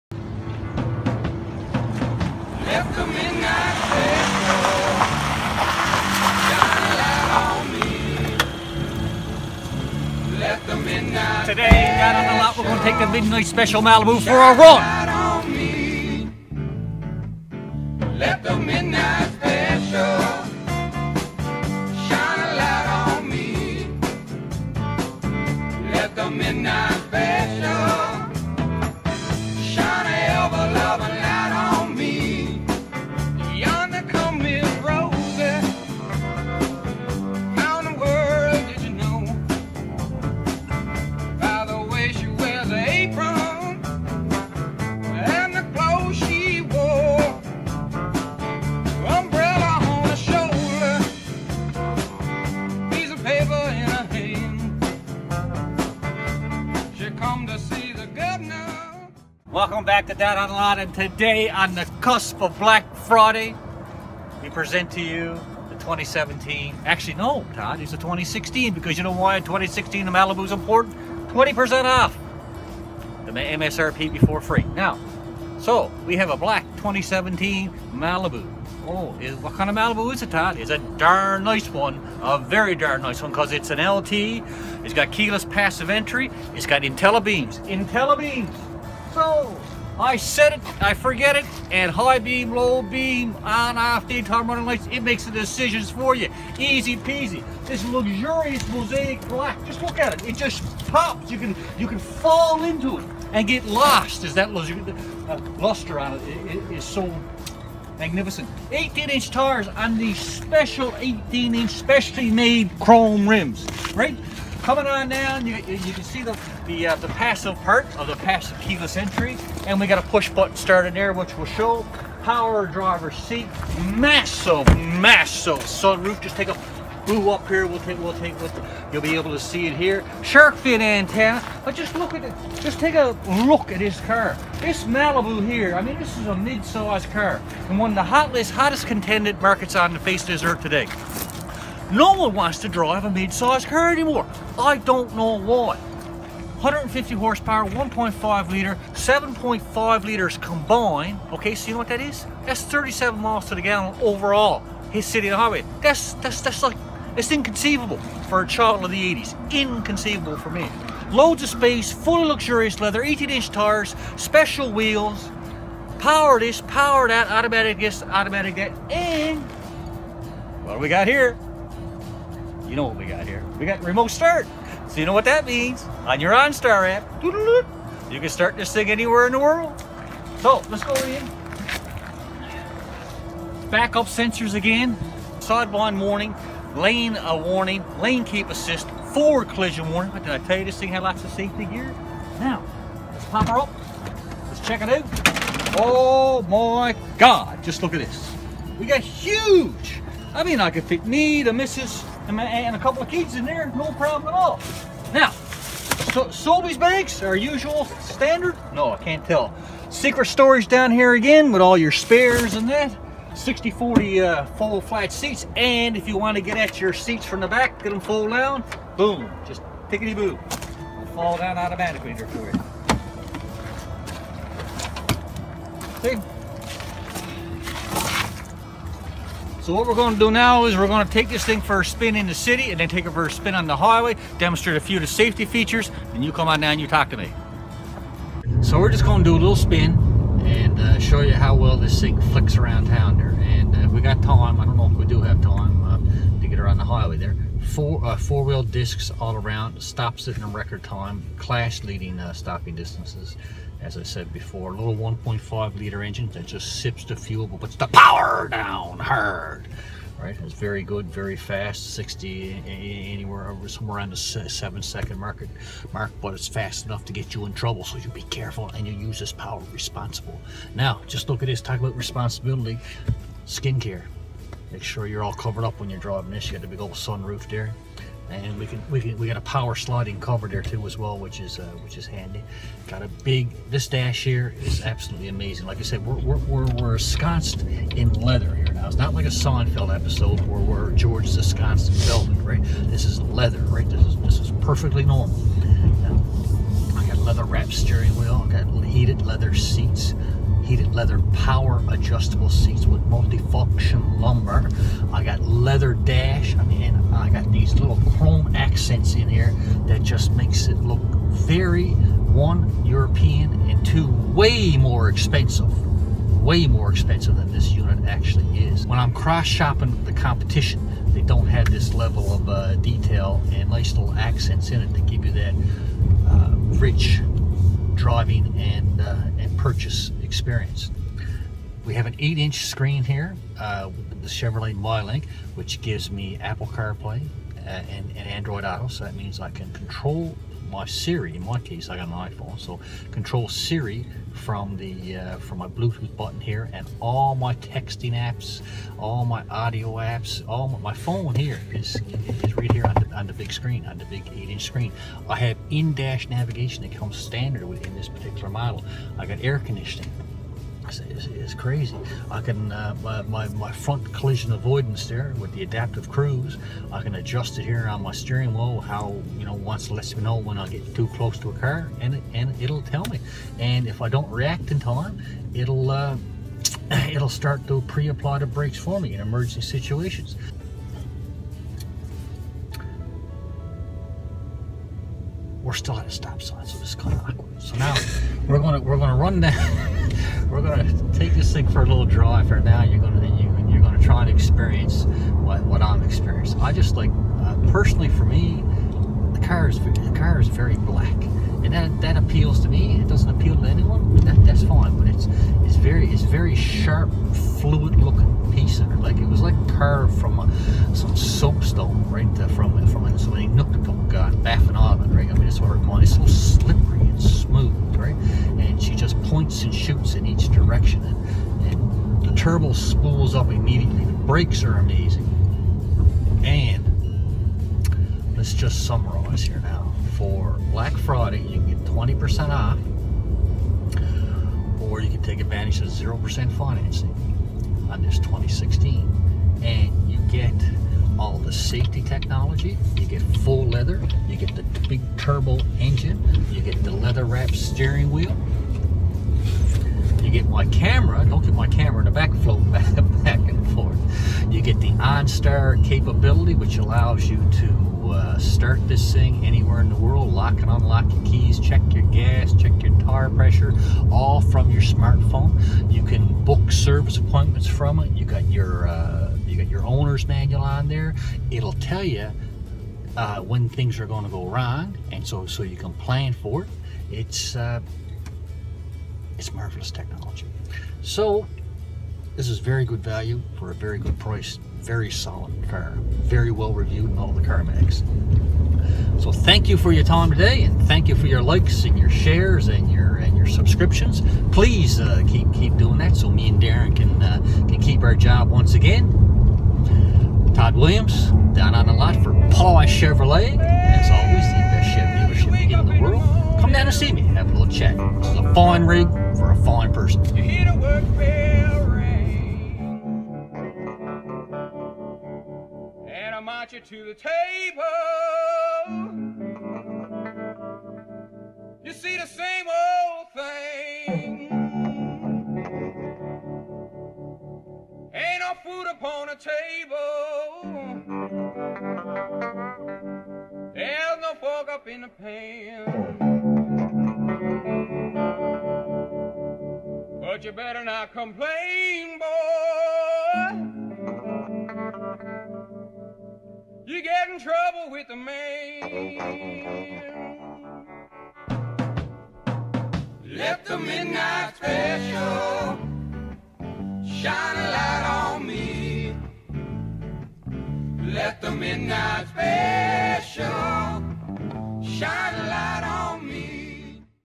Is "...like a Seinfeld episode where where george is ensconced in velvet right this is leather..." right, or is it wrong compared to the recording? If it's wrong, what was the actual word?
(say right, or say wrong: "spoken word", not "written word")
right.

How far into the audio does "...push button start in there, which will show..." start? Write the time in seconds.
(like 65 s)
120 s.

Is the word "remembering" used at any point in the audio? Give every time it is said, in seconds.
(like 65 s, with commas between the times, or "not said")
not said.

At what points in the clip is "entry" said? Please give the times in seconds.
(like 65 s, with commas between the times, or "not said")
85 s, 118 s.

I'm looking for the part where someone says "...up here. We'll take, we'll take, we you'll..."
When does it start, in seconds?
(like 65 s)
127 s.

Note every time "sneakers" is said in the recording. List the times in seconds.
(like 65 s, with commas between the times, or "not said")
not said.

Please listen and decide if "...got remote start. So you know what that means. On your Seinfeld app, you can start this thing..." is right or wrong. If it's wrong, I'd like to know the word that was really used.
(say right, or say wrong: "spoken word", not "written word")
wrong: "OnStar", not "Seinfeld".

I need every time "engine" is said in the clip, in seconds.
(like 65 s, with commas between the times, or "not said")
256 s, 445 s.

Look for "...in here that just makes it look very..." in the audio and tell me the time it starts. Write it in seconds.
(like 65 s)
309 s.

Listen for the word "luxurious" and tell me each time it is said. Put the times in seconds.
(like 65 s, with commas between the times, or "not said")
97 s, 162 s.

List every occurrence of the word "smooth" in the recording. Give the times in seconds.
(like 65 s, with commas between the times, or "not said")
417 s.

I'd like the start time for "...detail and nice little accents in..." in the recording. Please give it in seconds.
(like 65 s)
322 s.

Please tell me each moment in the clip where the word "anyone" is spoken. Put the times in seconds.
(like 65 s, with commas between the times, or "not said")
403 s.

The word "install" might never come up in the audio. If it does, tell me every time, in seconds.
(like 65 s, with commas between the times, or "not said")
not said.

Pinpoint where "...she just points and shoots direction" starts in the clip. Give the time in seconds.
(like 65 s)
418 s.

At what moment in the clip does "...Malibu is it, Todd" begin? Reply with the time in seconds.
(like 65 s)
79 s.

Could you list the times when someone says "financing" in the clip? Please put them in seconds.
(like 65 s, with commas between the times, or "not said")
436 s.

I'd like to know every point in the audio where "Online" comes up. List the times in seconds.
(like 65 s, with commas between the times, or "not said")
60 s.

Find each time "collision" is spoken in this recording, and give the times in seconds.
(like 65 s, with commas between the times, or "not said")
189 s, 364 s.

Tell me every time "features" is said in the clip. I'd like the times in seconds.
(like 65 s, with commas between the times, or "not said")
235 s.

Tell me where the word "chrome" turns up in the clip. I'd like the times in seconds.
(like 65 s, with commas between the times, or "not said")
112 s, 308 s.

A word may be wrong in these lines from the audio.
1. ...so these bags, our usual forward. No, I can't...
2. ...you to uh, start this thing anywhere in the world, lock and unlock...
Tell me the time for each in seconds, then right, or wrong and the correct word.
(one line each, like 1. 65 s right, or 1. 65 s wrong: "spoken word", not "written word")
1. 206 s wrong: "standard", not "forward"
2. 457 s right.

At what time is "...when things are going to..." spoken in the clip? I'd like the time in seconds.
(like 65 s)
473 s.